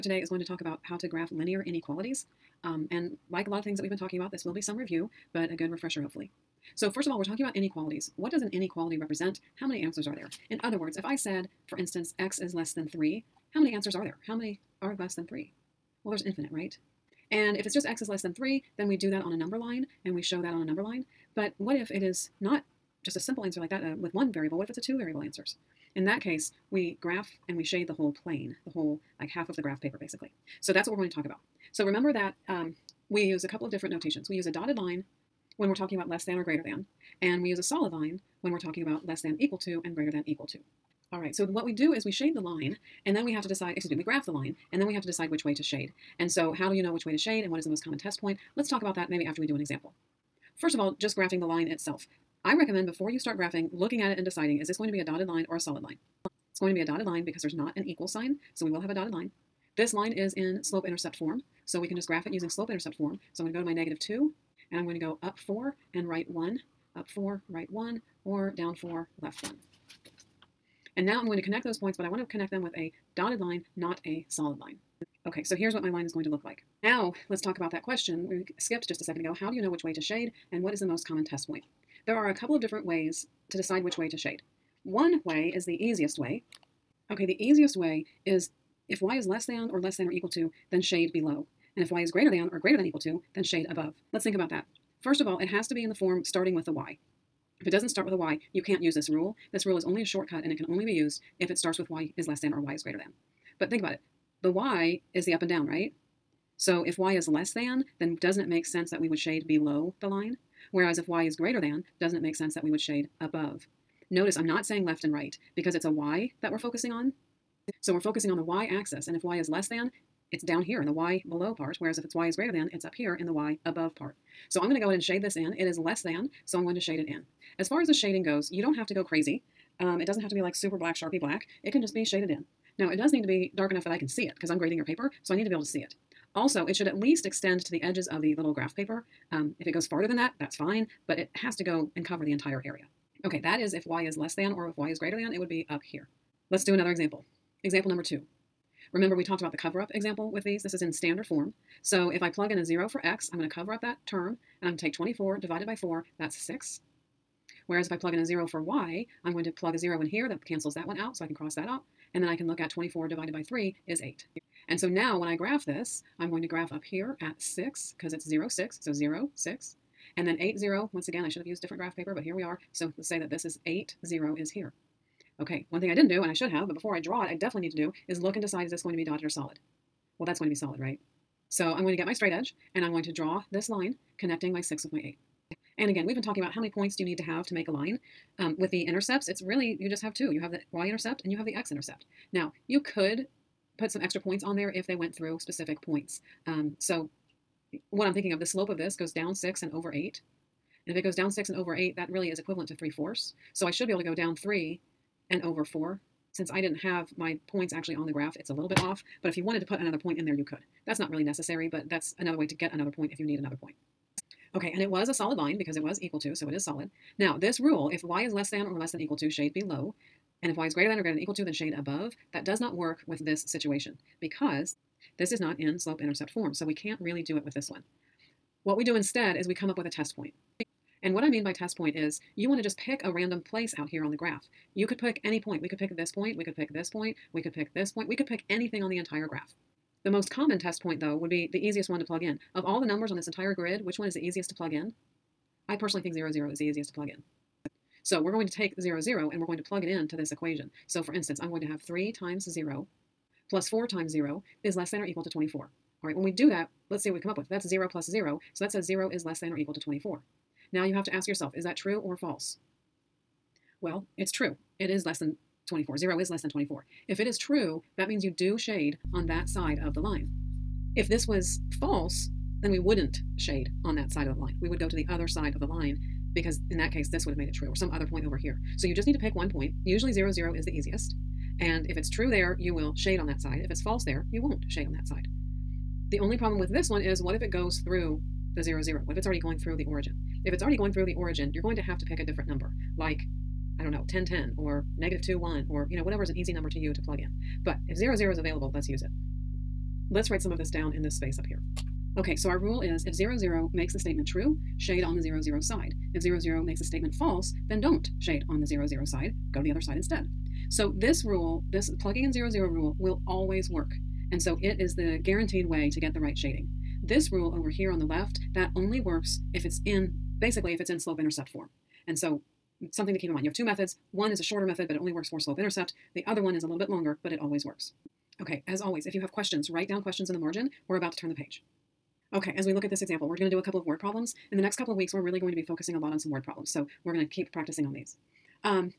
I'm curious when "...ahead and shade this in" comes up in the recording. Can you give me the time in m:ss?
2:04.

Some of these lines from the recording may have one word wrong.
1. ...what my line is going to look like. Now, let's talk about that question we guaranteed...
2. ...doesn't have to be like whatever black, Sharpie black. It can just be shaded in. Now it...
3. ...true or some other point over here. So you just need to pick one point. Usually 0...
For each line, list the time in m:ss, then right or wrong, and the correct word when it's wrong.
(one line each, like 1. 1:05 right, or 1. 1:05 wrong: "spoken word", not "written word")
1. 1:15 wrong: "skipped", not "guaranteed"
2. 2:10 wrong: "super", not "whatever"
3. 4:37 right.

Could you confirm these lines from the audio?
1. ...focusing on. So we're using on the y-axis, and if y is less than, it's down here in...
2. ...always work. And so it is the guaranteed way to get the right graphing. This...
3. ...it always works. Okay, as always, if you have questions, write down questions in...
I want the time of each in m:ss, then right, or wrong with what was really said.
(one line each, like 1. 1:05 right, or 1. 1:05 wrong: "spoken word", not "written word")
1. 1:56 wrong: "focusing", not "using"
2. 5:13 wrong: "shading", not "graphing"
3. 5:27 right.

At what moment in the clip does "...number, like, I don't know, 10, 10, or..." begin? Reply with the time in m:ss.
4:52.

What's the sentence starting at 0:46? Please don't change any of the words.
And so how do you know which way to shade and what is the most common test point?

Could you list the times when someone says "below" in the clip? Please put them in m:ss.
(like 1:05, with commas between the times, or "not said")
1:31, 1:49, 2:01, 3:39.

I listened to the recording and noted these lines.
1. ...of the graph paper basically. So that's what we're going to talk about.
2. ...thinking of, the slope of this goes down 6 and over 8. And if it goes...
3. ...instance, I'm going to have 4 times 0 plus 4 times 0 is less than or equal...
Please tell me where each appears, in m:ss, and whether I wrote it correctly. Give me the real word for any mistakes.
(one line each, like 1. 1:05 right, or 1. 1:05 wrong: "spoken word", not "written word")
1. 0:29 right
2. 3:18 right
3. 4:11 wrong: "3", not "4".